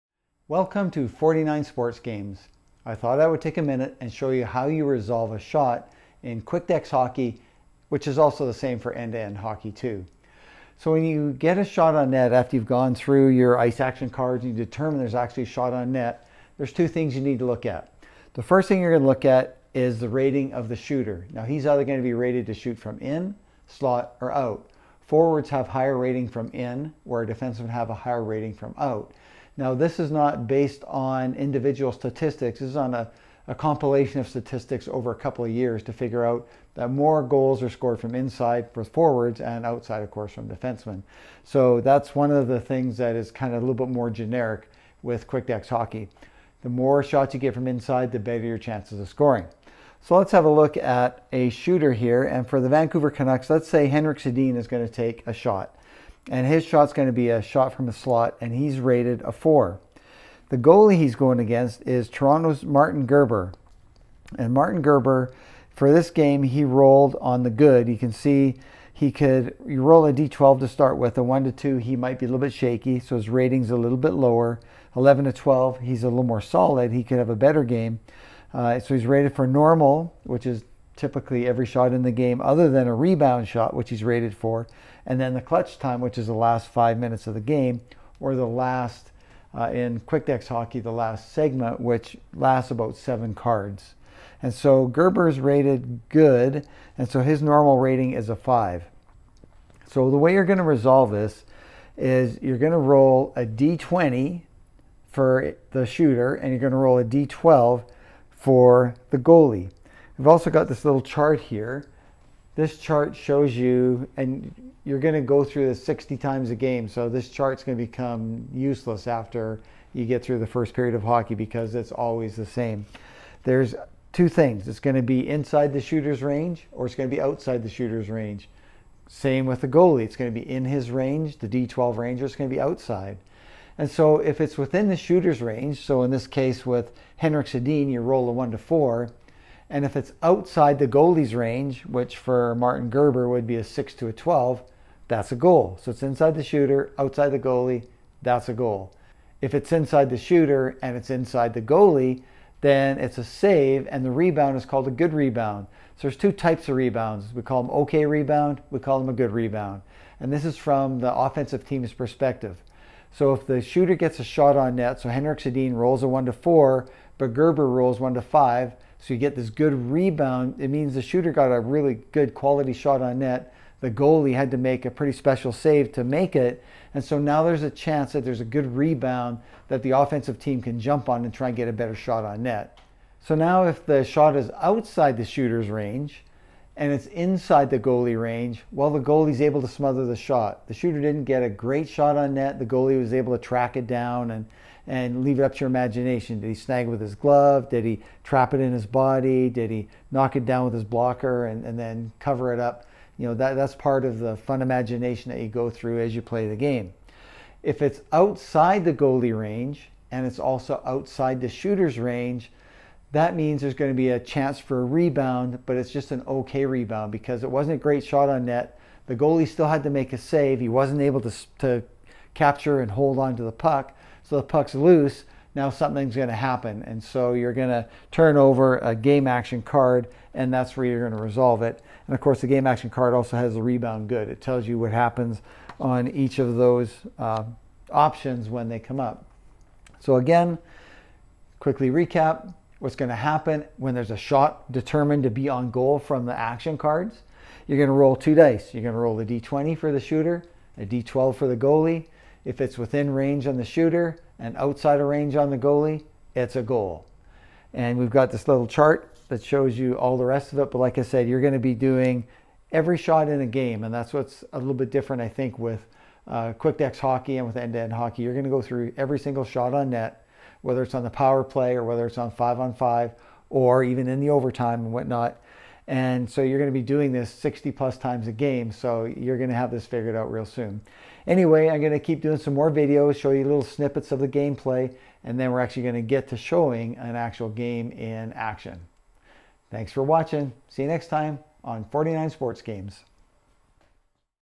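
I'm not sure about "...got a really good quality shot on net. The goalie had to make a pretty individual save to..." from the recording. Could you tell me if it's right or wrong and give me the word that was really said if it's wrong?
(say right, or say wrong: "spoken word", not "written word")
wrong: "special", not "individual".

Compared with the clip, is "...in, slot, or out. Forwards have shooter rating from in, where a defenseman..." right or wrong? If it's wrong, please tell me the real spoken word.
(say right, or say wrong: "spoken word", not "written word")
wrong: "higher", not "shooter".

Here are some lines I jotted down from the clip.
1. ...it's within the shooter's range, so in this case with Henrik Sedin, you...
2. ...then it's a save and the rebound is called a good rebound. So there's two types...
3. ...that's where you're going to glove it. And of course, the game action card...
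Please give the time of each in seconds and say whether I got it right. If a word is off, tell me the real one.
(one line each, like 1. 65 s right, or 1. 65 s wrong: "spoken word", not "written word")
1. 134 s right
2. 152 s right
3. 230 s wrong: "resolve", not "glove".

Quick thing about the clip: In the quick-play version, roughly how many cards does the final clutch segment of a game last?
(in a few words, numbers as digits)
7.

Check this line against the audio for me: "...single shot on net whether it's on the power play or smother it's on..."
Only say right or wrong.
wrong.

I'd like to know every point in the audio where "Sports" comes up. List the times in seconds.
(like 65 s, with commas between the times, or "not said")
1 s, 292 s.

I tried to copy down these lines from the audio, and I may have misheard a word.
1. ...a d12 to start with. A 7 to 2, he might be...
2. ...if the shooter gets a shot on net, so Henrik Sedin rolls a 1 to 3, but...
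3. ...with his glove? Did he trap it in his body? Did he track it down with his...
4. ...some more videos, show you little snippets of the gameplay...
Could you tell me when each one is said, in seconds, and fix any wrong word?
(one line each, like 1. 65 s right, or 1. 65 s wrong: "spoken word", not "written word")
1. 70 s wrong: "1", not "7"
2. 163 s wrong: "4", not "3"
3. 196 s wrong: "knock", not "track"
4. 282 s right.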